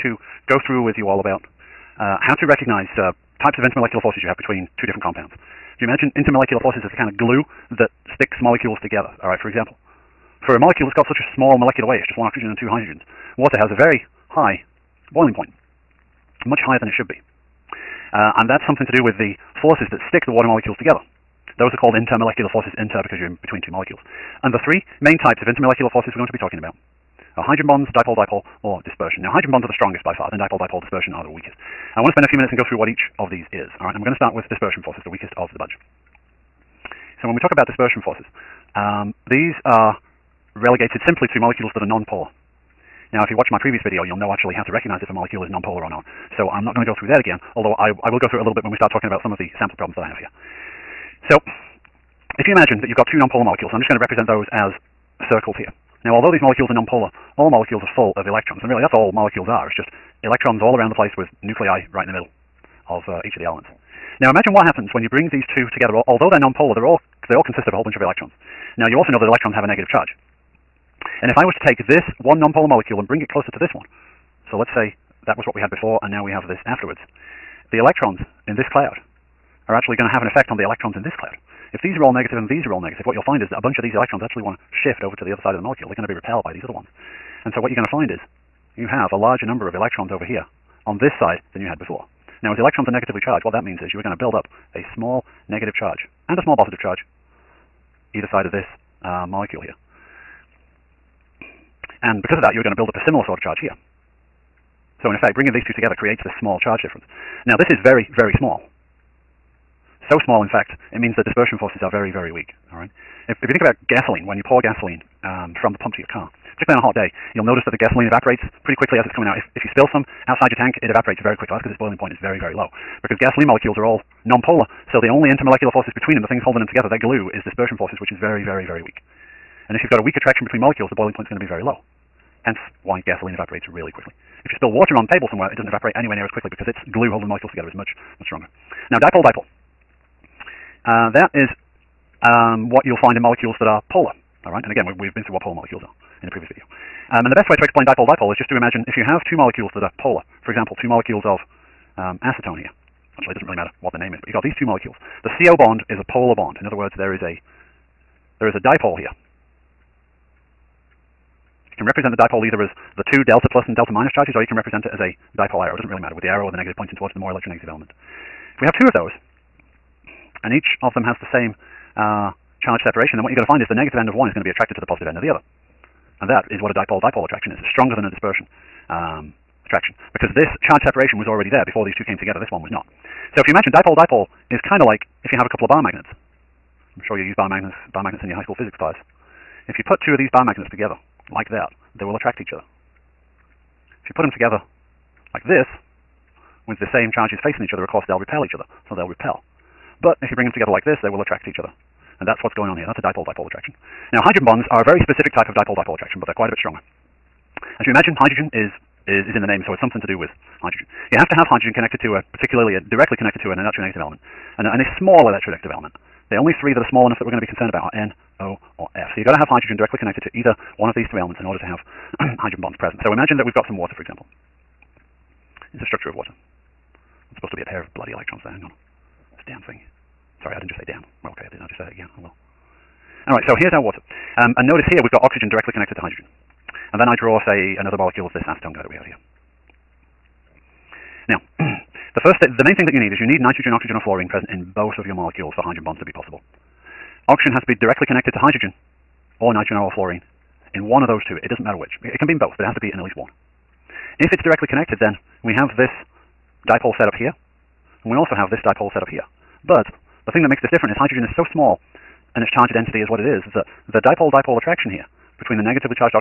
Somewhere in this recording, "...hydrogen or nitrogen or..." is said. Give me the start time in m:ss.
4:08.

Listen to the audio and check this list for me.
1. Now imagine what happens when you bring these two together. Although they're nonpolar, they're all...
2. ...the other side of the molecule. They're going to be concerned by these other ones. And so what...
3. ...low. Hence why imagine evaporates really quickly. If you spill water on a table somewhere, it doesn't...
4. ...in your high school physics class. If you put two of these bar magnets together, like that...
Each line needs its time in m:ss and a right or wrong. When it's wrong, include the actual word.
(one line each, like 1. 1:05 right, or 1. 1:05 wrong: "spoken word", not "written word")
1. 1:04 right
2. 1:25 wrong: "repelled", not "concerned"
3. 2:11 wrong: "gasoline", not "imagine"
4. 3:08 right.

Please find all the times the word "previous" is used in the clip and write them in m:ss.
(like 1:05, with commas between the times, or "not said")
0:43, 2:26.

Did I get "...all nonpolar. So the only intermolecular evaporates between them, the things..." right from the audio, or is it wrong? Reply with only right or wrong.
wrong.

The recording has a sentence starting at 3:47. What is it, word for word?
It's supposed to be a pair of bloody electrons there.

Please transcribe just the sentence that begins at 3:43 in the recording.
So imagine that we've got some water, for example.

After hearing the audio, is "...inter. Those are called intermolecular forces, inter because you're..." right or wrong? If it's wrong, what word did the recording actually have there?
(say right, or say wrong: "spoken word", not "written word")
wrong: "together", not "inter".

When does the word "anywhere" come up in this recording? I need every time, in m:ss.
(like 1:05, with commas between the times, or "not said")
2:15.